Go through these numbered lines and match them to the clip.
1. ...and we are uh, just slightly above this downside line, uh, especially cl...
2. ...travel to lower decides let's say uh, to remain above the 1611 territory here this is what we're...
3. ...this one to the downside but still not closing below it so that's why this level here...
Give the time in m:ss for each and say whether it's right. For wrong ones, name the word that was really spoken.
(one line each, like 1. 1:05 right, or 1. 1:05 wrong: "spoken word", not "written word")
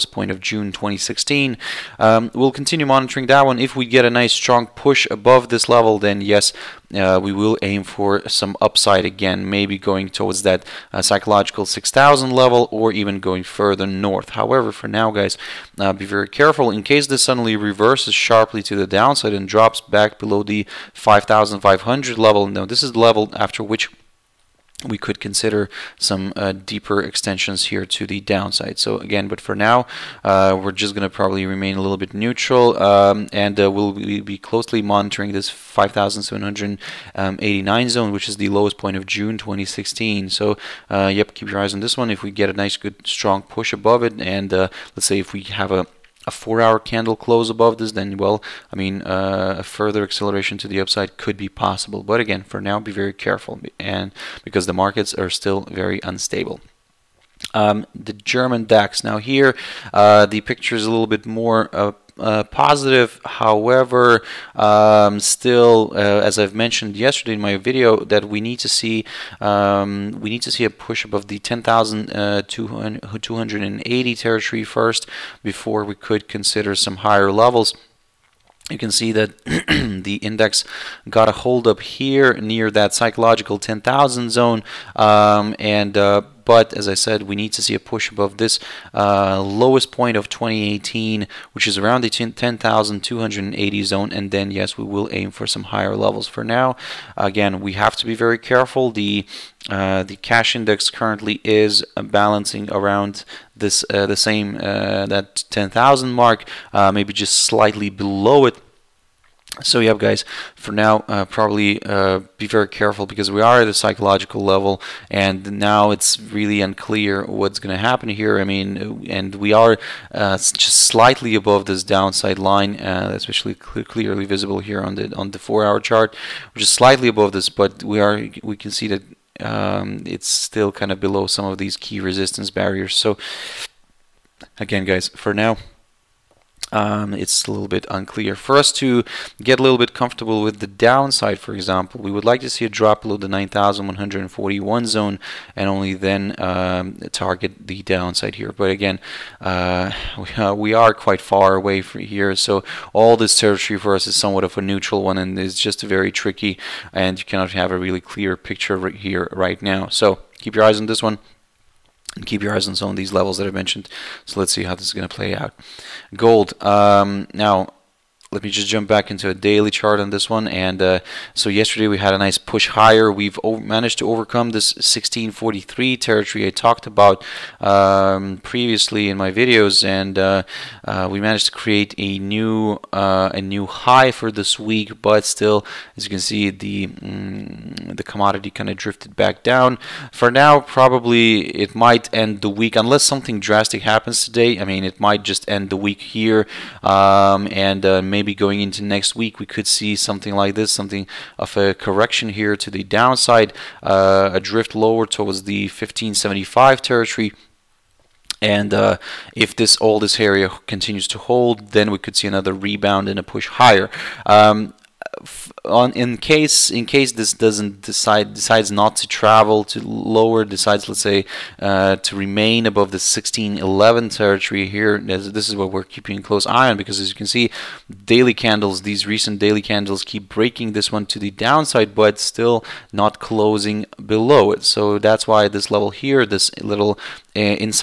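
1. 1:59 right
2. 3:39 right
3. 3:50 right.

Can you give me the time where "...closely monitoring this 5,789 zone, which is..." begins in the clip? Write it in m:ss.
0:34.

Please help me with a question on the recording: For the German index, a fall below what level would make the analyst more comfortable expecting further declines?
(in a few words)
9,141.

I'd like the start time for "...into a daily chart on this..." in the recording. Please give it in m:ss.
2:49.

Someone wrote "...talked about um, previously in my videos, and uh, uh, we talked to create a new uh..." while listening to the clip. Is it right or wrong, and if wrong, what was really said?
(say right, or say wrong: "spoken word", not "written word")
wrong: "managed", not "talked".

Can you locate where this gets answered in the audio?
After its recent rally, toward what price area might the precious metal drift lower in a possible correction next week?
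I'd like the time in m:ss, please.
3:25.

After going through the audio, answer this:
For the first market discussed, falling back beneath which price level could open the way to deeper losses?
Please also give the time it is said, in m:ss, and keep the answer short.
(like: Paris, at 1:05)
5500, at 0:20.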